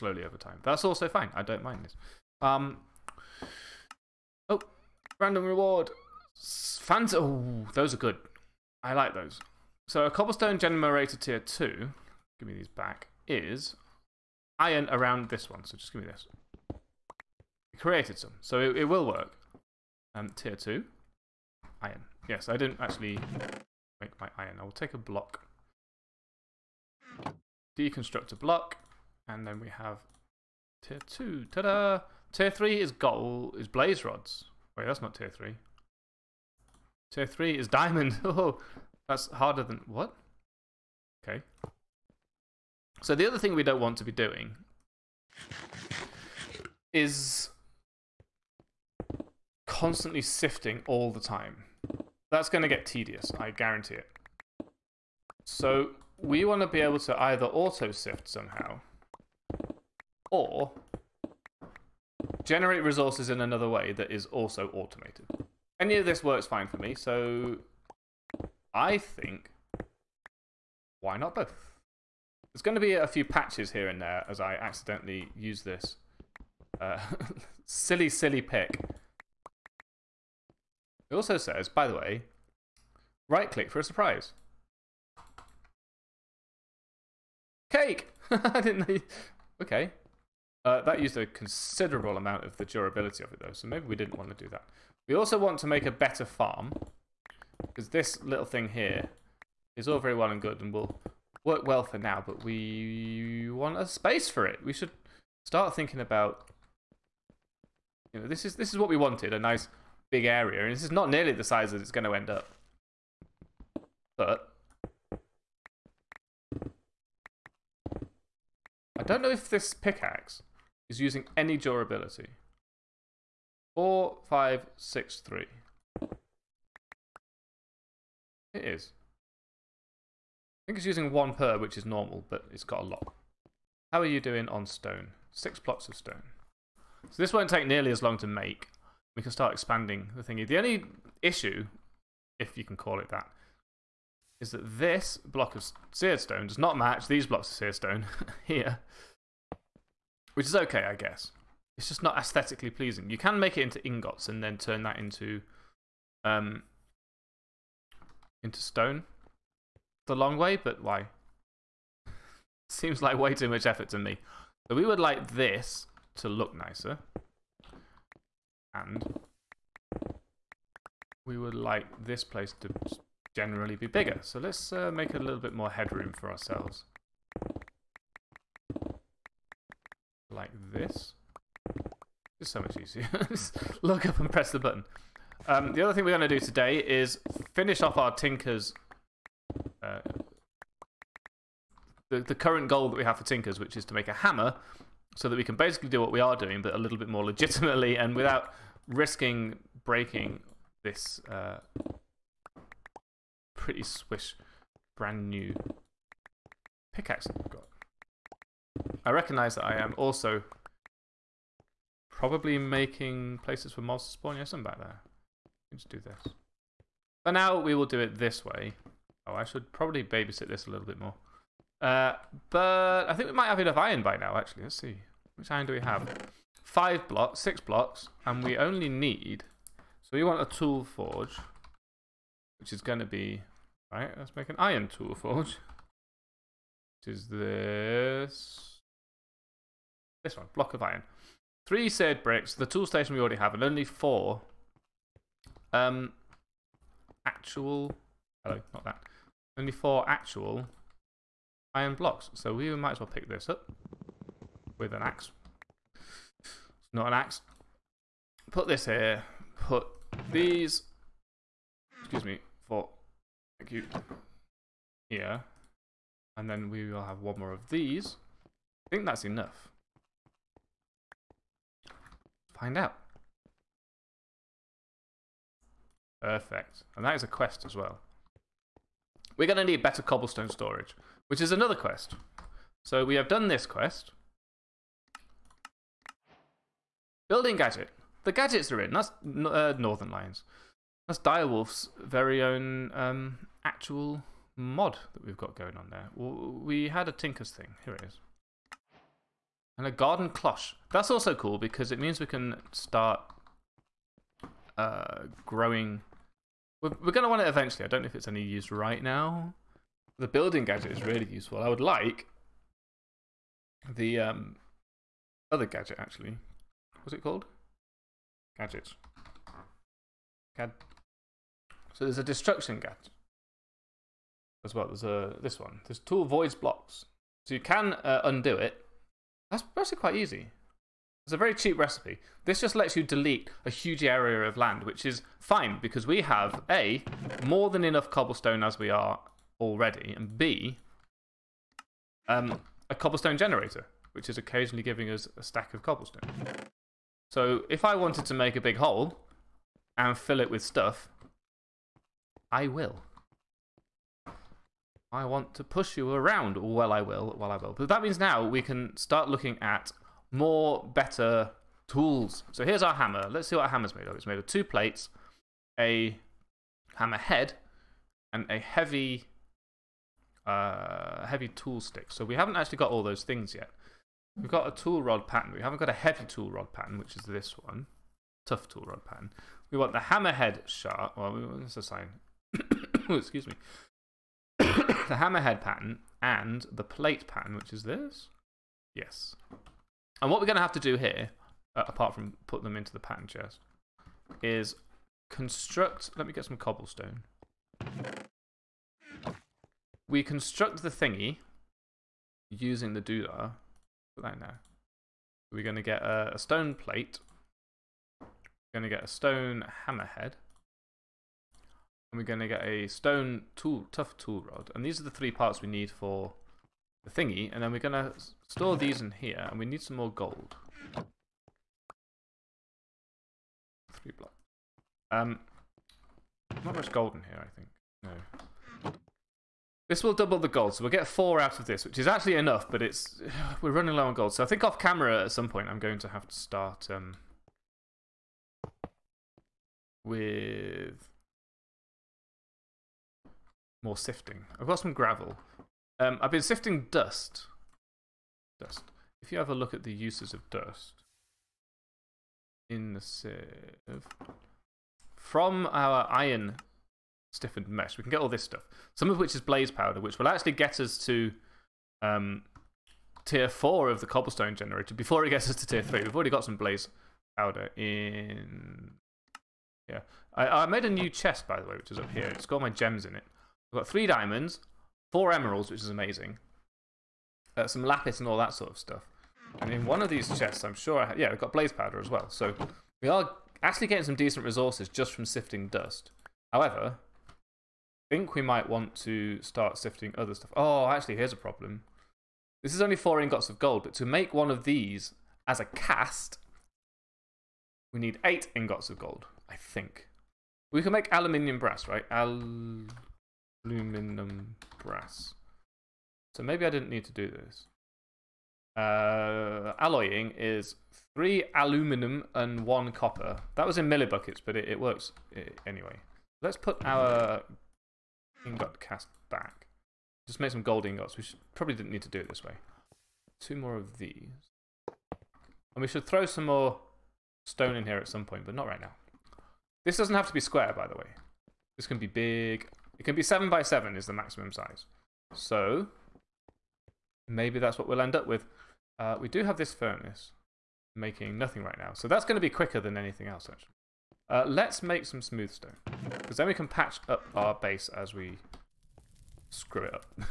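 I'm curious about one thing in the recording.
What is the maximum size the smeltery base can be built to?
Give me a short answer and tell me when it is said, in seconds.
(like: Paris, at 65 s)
7 by 7, at 533 s.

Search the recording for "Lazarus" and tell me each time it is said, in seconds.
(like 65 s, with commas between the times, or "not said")
not said.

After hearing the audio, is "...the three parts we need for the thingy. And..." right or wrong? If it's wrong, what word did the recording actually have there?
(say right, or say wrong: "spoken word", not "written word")
right.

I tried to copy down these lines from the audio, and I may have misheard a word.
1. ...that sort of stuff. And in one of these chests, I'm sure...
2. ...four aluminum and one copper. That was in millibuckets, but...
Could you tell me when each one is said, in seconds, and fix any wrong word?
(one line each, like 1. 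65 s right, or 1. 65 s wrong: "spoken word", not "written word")
1. 478 s right
2. 511 s wrong: "three", not "four".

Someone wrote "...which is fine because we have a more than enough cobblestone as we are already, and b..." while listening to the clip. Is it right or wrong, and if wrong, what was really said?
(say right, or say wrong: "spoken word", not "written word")
right.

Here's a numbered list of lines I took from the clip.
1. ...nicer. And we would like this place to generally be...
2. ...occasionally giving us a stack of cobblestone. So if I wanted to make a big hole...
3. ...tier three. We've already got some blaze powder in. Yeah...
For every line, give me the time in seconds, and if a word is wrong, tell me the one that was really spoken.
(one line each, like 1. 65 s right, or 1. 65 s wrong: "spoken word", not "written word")
1. 166 s right
2. 344 s right
3. 465 s right.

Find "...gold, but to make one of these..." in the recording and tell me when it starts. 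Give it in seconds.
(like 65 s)
493 s.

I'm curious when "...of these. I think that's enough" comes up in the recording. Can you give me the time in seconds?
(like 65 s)
267 s.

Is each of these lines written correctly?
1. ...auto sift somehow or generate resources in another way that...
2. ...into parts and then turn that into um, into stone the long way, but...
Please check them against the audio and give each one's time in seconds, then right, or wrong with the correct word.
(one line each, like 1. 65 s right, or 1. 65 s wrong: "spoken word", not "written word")
1. 57 s right
2. 153 s wrong: "ingots", not "parts".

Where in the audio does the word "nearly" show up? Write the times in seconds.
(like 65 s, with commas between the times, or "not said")
111 s, 137 s.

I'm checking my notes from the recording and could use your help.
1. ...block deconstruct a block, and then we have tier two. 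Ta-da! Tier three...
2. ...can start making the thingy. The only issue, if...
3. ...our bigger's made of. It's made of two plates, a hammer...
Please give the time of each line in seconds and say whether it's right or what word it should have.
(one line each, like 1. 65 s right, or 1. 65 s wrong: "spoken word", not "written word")
1. 24 s right
2. 139 s wrong: "expanding", not "making"
3. 363 s wrong: "hammer", not "bigger".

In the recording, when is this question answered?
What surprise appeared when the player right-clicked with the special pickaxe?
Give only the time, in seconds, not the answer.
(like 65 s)
87 s.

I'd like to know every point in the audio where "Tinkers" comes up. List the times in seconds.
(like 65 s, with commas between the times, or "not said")
188 s, 193 s, 297 s.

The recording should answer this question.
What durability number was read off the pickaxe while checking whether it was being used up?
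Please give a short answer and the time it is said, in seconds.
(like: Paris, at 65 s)
4563, at 123 s.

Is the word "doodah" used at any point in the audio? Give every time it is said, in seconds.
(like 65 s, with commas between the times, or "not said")
403 s.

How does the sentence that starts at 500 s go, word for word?
We can make aluminium brass, right?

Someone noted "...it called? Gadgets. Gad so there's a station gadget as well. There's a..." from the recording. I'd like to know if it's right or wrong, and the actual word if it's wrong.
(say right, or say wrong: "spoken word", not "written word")
wrong: "destruction", not "station".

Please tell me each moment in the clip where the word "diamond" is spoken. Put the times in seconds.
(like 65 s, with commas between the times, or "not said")
37 s, 474 s.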